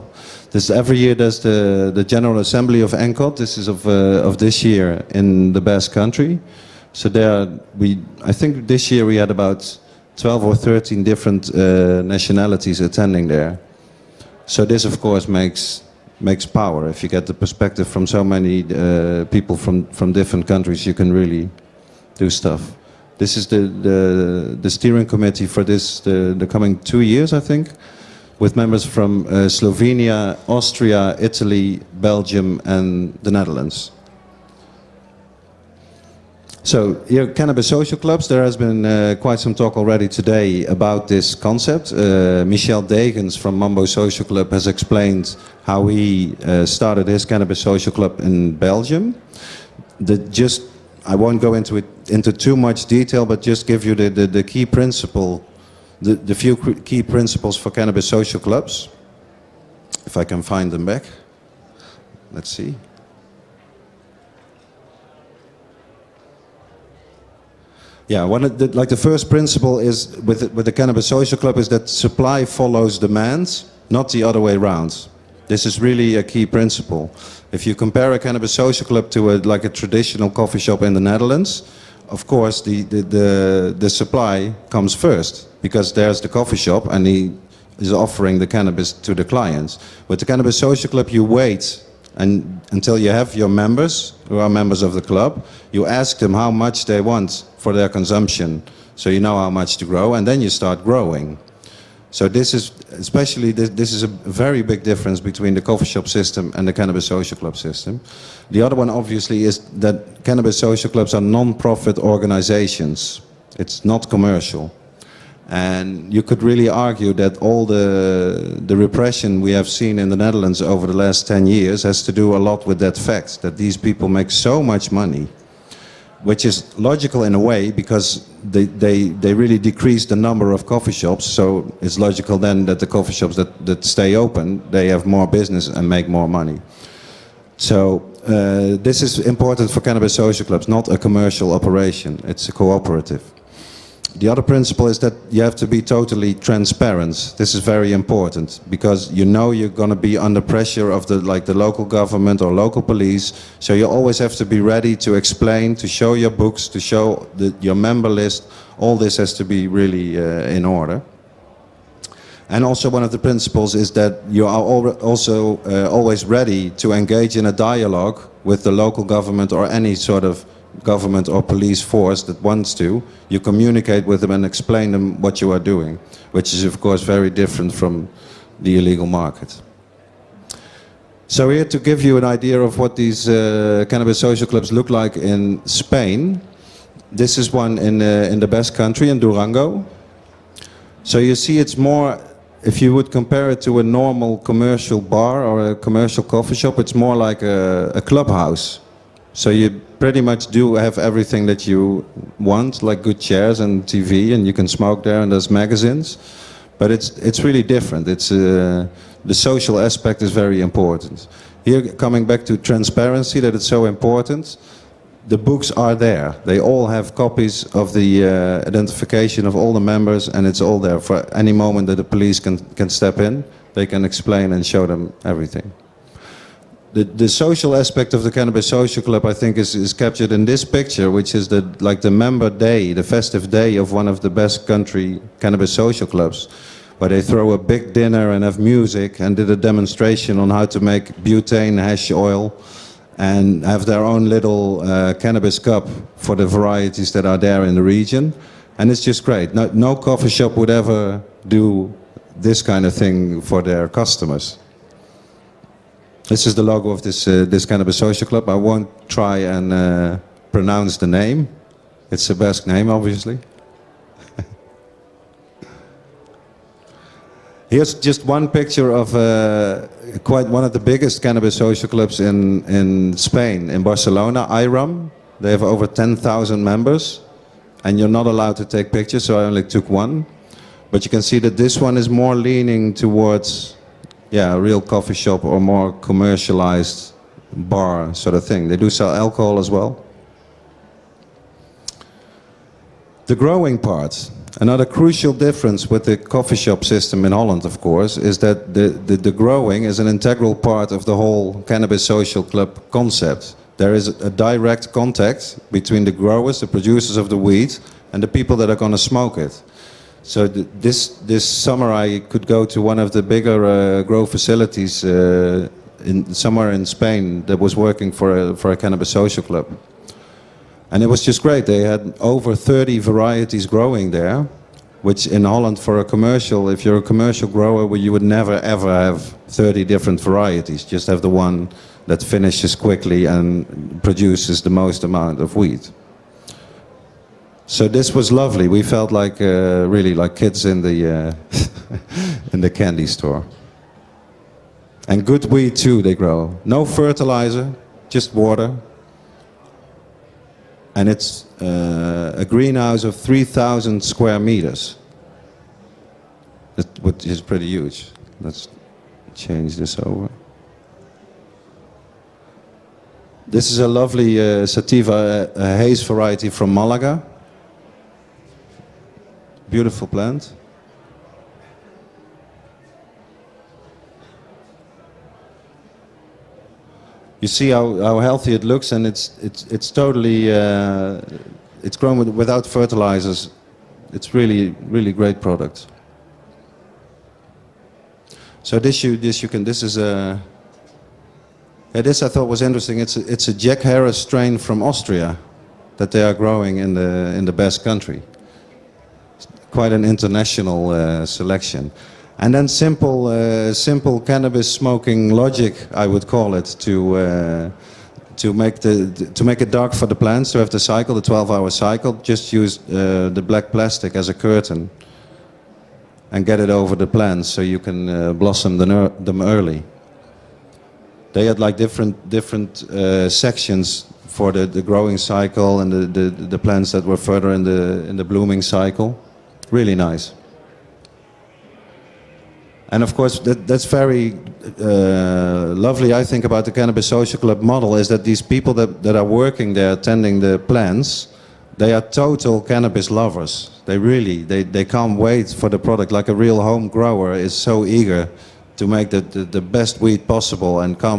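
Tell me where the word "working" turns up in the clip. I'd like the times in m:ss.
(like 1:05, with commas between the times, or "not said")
5:17, 7:19.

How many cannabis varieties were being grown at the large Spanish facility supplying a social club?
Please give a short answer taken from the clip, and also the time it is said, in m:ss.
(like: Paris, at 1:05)
over 30, at 5:22.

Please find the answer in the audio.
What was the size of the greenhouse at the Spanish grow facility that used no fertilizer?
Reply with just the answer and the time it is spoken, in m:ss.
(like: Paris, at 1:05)
3,000 square meters, at 5:53.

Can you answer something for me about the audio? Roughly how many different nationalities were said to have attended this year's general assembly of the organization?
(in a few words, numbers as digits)
12 or 13.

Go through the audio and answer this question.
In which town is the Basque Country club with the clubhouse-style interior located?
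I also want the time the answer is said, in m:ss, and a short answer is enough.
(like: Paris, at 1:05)
Durango, at 3:09.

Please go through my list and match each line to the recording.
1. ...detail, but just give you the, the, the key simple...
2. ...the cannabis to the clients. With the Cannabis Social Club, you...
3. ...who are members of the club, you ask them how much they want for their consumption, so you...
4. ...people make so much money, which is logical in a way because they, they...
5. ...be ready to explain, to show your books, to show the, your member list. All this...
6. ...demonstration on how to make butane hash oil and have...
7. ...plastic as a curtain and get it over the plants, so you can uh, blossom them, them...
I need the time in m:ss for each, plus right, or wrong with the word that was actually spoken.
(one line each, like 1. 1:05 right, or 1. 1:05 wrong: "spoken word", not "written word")
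1. 0:52 wrong: "principle", not "simple"
2. 1:28 right
3. 1:34 right
4. 2:03 right
5. 2:34 right
6. 3:59 right
7. 6:53 right.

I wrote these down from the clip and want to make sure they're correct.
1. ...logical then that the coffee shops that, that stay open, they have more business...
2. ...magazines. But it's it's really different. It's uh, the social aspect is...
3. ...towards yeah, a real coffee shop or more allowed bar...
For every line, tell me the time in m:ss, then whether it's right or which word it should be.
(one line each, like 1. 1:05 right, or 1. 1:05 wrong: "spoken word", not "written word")
1. 2:11 right
2. 3:25 right
3. 4:42 wrong: "commercialized", not "allowed".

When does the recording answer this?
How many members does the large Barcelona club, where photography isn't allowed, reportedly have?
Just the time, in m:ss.
4:35.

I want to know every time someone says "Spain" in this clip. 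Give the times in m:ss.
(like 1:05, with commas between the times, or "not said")
3:05, 4:33, 5:16.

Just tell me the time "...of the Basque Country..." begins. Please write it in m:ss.
3:54.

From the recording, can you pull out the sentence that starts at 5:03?
There is a direct contact between the growers, the producers of the weed, and the people that are going to smoke it.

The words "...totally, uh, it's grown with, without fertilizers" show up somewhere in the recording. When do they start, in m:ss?
6:19.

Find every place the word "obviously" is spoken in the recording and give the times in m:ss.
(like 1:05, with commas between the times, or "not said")
1:48, 4:22.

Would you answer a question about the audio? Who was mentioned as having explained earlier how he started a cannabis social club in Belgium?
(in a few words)
Michel Degens.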